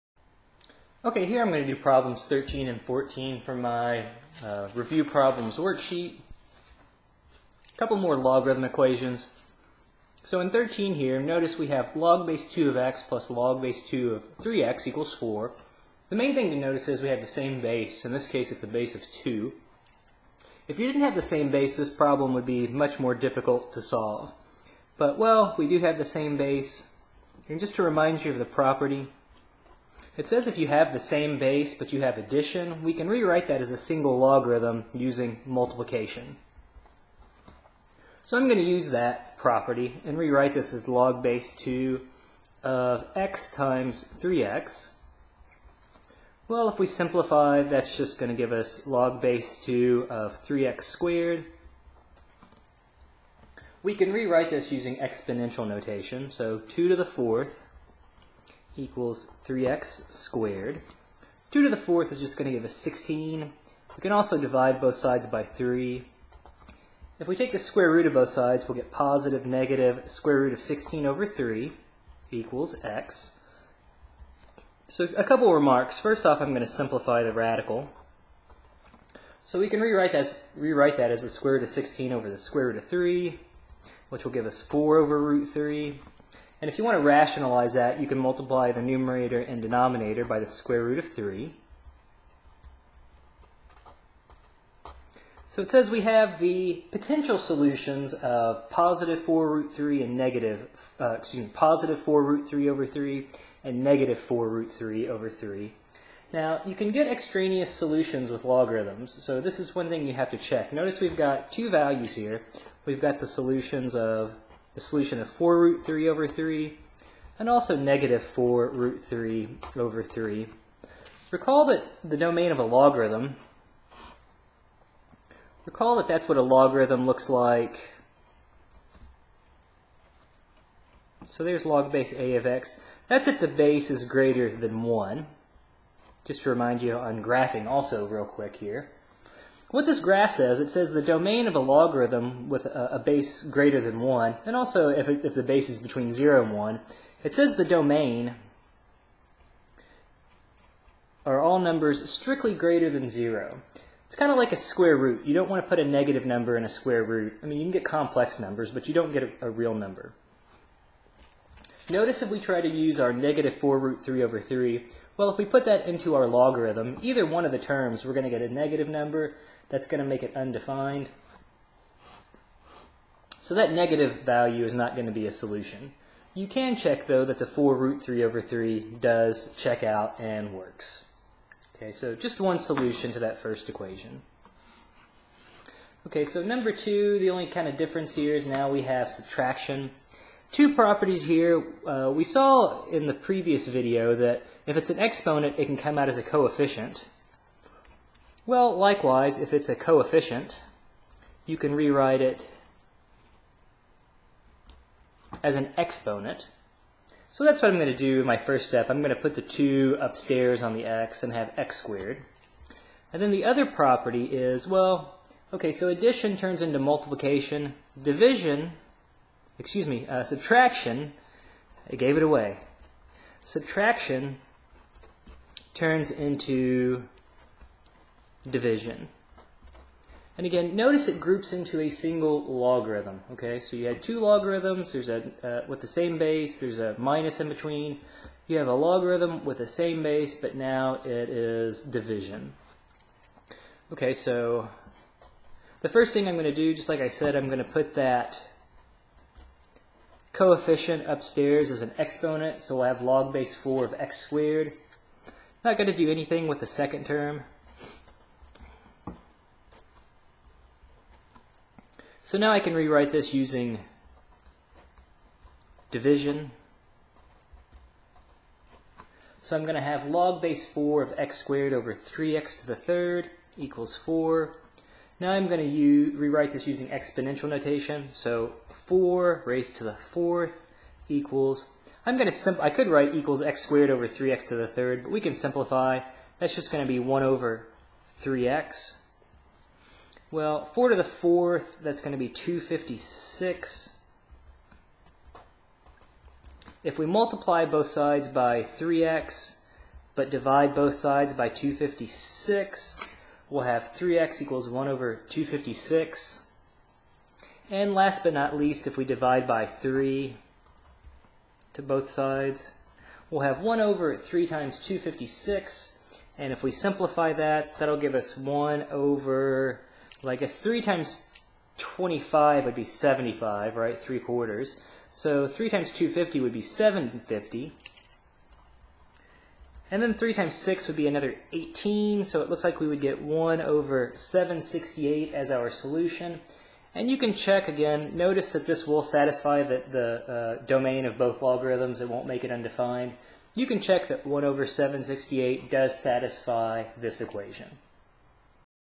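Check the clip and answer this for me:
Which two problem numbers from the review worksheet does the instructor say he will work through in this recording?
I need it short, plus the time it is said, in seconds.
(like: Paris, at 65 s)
13 and 14, at 2 s.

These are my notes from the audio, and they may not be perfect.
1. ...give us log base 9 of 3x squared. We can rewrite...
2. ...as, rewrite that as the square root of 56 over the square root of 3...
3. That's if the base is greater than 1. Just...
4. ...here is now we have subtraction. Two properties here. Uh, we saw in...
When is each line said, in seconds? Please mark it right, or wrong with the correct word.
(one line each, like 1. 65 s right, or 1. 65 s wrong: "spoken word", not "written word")
1. 48 s wrong: "2", not "9"
2. 80 s wrong: "16", not "56"
3. 133 s right
4. 188 s right.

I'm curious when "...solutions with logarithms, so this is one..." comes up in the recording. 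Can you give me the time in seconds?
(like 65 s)
107 s.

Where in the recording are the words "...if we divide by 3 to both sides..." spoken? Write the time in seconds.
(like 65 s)
308 s.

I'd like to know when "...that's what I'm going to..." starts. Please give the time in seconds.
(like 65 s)
207 s.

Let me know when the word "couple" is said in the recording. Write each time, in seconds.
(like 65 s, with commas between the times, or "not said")
7 s, 75 s.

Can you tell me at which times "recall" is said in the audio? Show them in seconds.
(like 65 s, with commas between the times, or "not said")
121 s, 125 s.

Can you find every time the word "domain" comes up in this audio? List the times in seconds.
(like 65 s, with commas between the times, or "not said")
122 s, 141 s, 147 s, 340 s.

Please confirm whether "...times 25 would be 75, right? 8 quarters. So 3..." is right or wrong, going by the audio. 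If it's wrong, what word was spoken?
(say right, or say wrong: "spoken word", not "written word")
wrong: "3", not "8".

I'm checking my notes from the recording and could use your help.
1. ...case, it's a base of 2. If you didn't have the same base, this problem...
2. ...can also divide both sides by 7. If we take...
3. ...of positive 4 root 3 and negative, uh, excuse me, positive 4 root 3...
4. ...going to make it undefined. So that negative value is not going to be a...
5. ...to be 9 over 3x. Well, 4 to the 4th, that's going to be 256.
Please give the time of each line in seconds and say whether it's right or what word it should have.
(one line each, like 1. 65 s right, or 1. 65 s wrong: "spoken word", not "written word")
1. 18 s right
2. 64 s wrong: "3", not "7"
3. 98 s right
4. 169 s right
5. 286 s wrong: "1", not "9".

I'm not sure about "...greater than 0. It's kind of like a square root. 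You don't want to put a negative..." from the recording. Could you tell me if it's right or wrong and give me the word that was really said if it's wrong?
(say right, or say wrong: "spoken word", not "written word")
right.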